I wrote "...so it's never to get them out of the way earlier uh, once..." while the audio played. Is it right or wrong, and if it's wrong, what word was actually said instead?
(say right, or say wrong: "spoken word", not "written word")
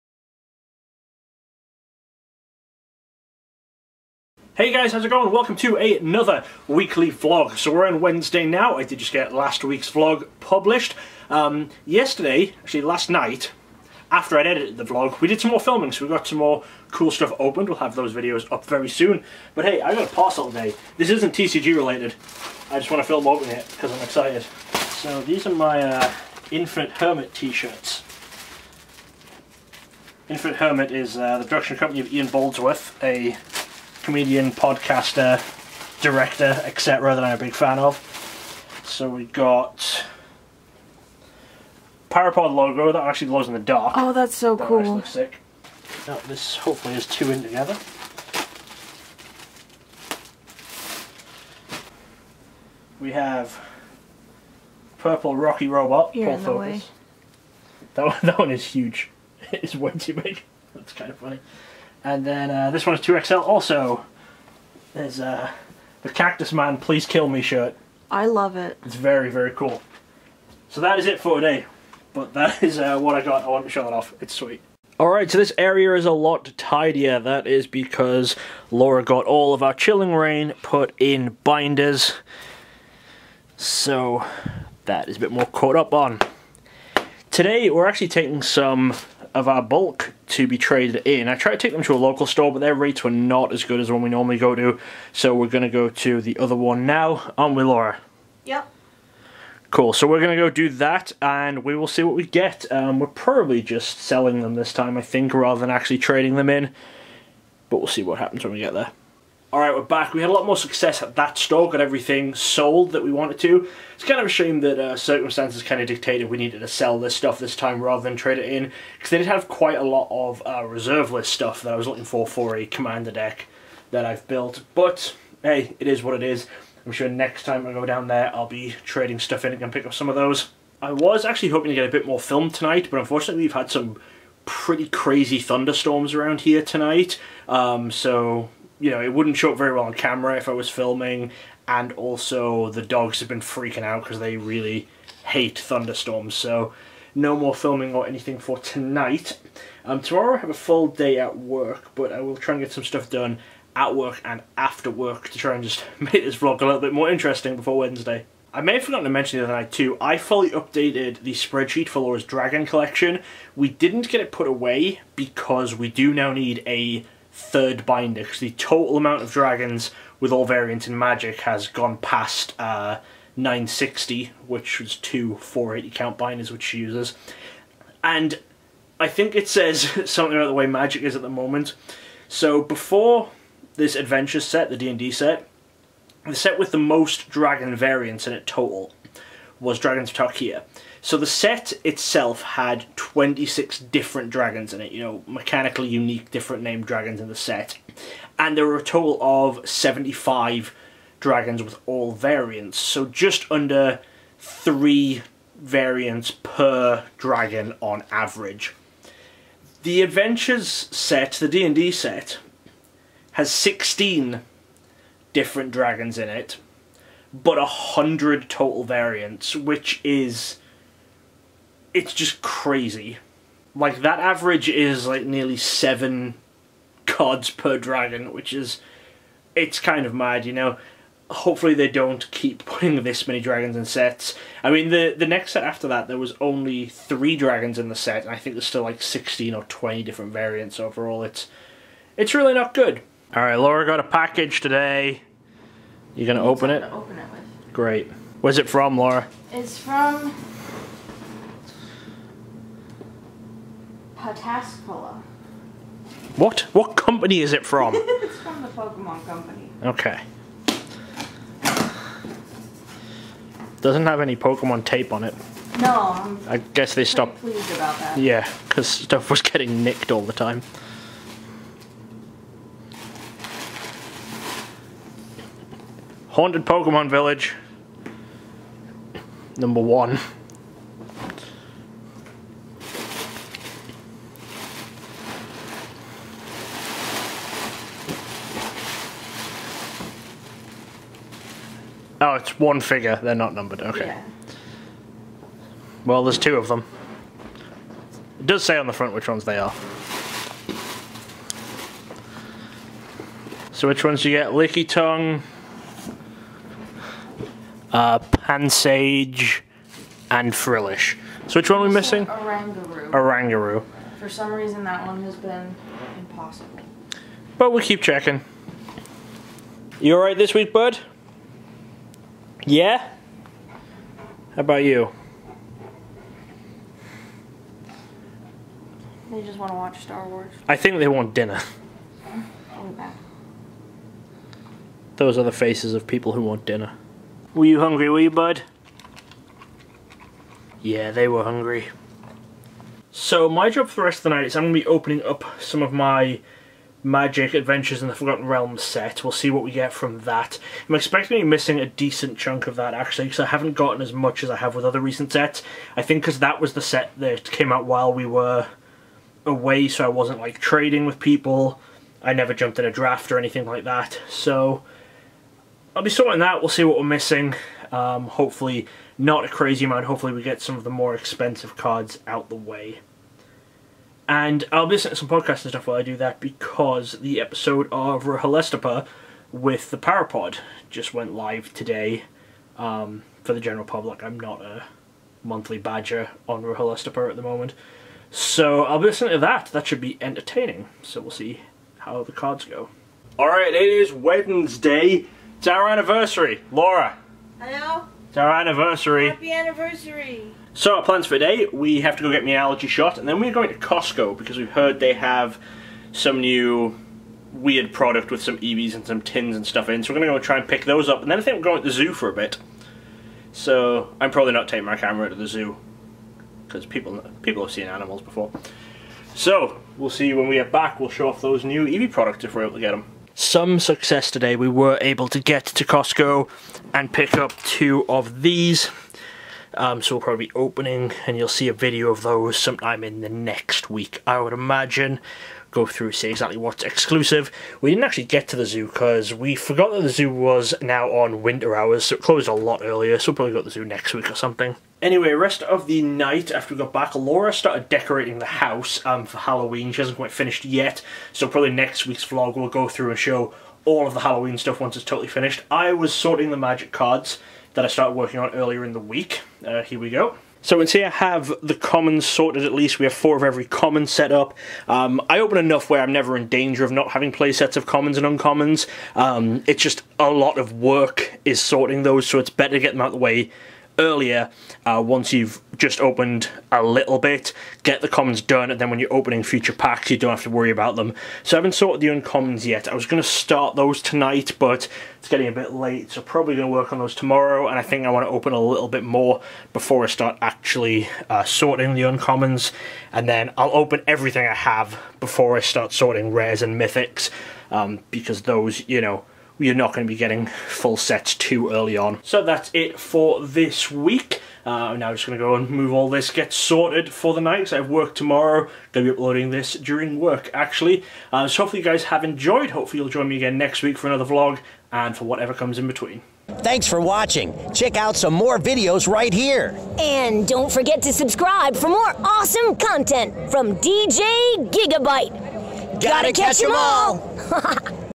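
wrong: "better", not "never".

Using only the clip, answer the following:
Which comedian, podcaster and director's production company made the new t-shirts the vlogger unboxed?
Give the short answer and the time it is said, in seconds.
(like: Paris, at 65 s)
Ian Boldsworth, at 32 s.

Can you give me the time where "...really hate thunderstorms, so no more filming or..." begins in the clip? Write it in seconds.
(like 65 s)
144 s.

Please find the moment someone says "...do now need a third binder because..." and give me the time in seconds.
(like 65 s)
165 s.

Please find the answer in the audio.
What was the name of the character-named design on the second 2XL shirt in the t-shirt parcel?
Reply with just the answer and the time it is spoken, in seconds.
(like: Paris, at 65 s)
Cactus Man Please Kill Me, at 66 s.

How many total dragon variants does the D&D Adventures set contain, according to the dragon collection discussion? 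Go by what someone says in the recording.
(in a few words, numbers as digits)
100.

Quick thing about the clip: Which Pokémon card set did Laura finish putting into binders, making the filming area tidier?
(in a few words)
Chilling Reign.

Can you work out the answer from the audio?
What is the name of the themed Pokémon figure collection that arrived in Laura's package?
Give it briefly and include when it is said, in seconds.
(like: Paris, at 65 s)
Haunted Pokemon Village, at 276 s.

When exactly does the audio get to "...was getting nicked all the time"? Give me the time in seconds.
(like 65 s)
269 s.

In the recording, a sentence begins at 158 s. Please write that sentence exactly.
I may have forgotten to mention the other night too, I fully updated the spreadsheet for Laura's Dragon collection.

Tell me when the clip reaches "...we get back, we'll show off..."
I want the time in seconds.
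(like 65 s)
420 s.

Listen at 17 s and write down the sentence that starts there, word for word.
We'll have those videos up very soon.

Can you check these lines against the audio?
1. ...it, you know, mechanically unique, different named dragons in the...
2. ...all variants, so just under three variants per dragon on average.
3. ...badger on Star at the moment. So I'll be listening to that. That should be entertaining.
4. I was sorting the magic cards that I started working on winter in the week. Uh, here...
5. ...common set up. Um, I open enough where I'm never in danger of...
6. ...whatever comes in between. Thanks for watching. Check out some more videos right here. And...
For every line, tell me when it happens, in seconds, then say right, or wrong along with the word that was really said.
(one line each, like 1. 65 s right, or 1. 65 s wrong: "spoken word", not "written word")
1. 194 s right
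2. 201 s right
3. 385 s wrong: "Rahalestapa", not "Star"
4. 455 s wrong: "earlier", not "winter"
5. 463 s right
6. 515 s right.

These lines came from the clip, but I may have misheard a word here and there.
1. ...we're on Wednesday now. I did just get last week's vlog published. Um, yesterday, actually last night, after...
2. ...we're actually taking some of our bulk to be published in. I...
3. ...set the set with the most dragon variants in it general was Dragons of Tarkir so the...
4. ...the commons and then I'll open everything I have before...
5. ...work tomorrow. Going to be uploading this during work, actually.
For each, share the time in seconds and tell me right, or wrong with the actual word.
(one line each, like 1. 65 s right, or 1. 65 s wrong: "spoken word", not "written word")
1. 7 s right
2. 87 s wrong: "traded", not "published"
3. 185 s wrong: "total", not "general"
4. 491 s wrong: "uncommons", not "commons"
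5. 507 s right.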